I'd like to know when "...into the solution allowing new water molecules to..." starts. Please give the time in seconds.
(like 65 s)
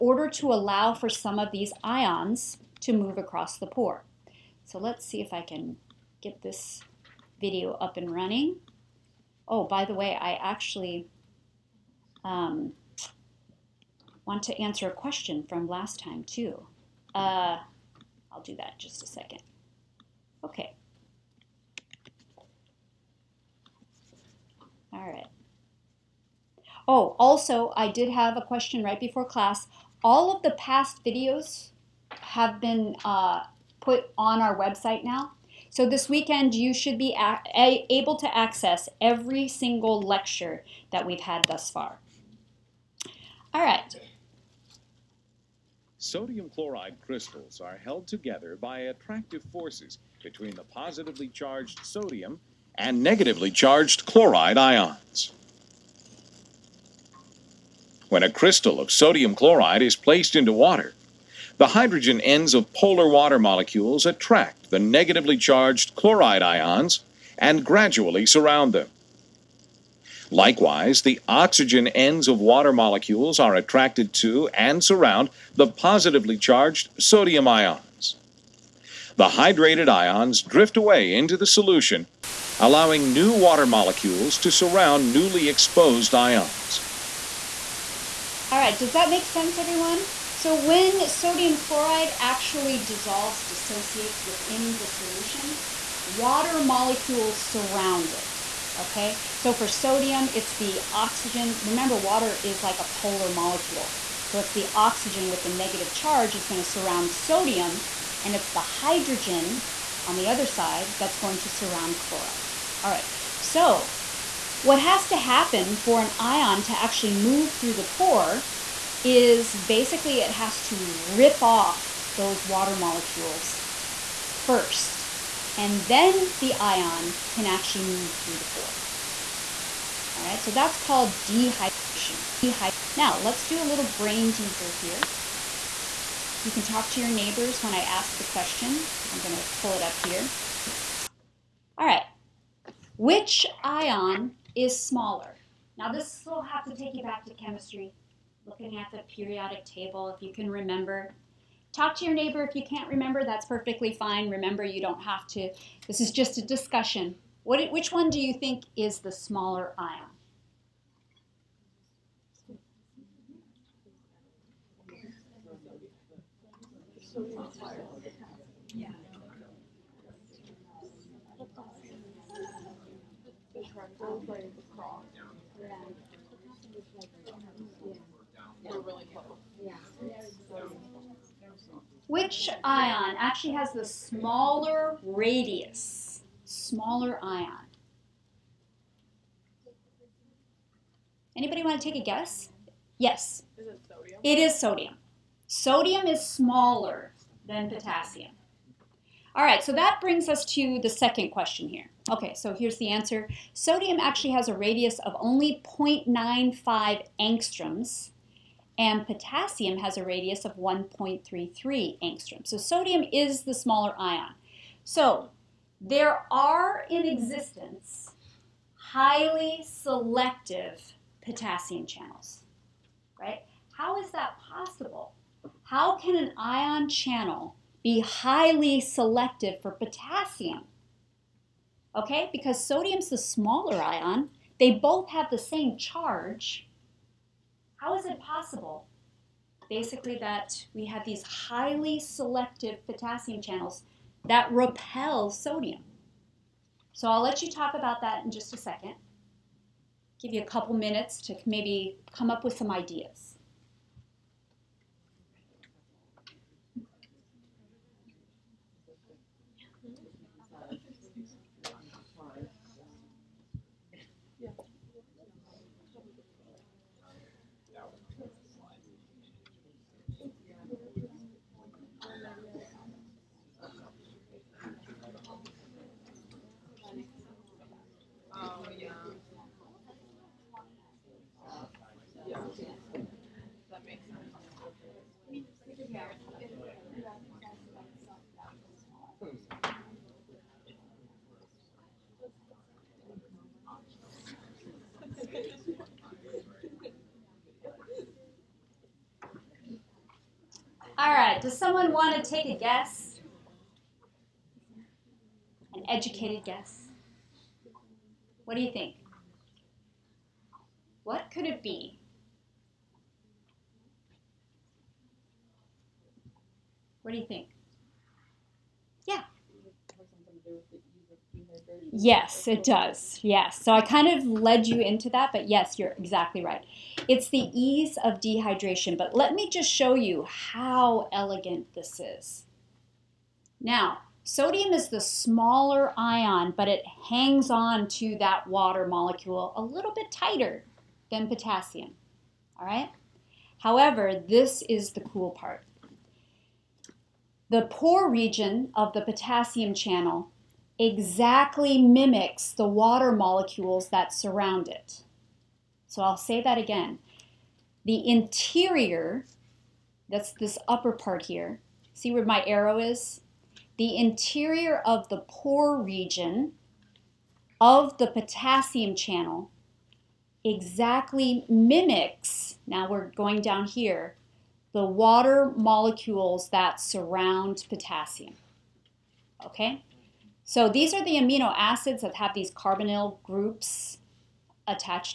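81 s.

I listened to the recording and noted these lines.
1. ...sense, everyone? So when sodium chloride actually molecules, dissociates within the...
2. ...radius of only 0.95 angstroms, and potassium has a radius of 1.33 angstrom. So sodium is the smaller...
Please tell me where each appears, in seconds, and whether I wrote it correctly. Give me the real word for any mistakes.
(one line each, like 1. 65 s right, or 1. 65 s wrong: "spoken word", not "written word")
1. 89 s wrong: "dissolves", not "molecules"
2. 204 s right.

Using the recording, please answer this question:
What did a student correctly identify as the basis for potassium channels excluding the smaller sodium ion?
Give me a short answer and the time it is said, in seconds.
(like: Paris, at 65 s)
Ease of dehydration, at 327 s.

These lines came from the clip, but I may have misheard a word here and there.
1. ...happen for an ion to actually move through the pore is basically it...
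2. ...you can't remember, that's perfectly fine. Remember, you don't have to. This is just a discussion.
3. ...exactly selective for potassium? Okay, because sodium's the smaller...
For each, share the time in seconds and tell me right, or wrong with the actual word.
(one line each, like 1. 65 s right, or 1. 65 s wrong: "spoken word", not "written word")
1. 115 s right
2. 152 s right
3. 228 s wrong: "highly", not "exactly".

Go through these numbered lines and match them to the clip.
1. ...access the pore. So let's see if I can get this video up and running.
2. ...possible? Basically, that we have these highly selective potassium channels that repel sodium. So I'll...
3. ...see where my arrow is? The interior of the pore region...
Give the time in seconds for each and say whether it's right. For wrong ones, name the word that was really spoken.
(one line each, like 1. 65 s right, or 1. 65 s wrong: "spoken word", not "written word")
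1. 3 s wrong: "across", not "access"
2. 238 s right
3. 361 s right.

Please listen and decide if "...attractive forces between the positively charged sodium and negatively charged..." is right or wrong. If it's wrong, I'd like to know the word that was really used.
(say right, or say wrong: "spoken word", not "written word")
right.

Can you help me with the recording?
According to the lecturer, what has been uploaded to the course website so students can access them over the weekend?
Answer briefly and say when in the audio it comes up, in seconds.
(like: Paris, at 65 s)
All of the past videos, at 30 s.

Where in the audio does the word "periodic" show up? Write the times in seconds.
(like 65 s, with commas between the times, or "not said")
149 s.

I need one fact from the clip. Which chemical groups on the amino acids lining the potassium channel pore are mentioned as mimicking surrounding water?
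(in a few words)
Carbonyl groups.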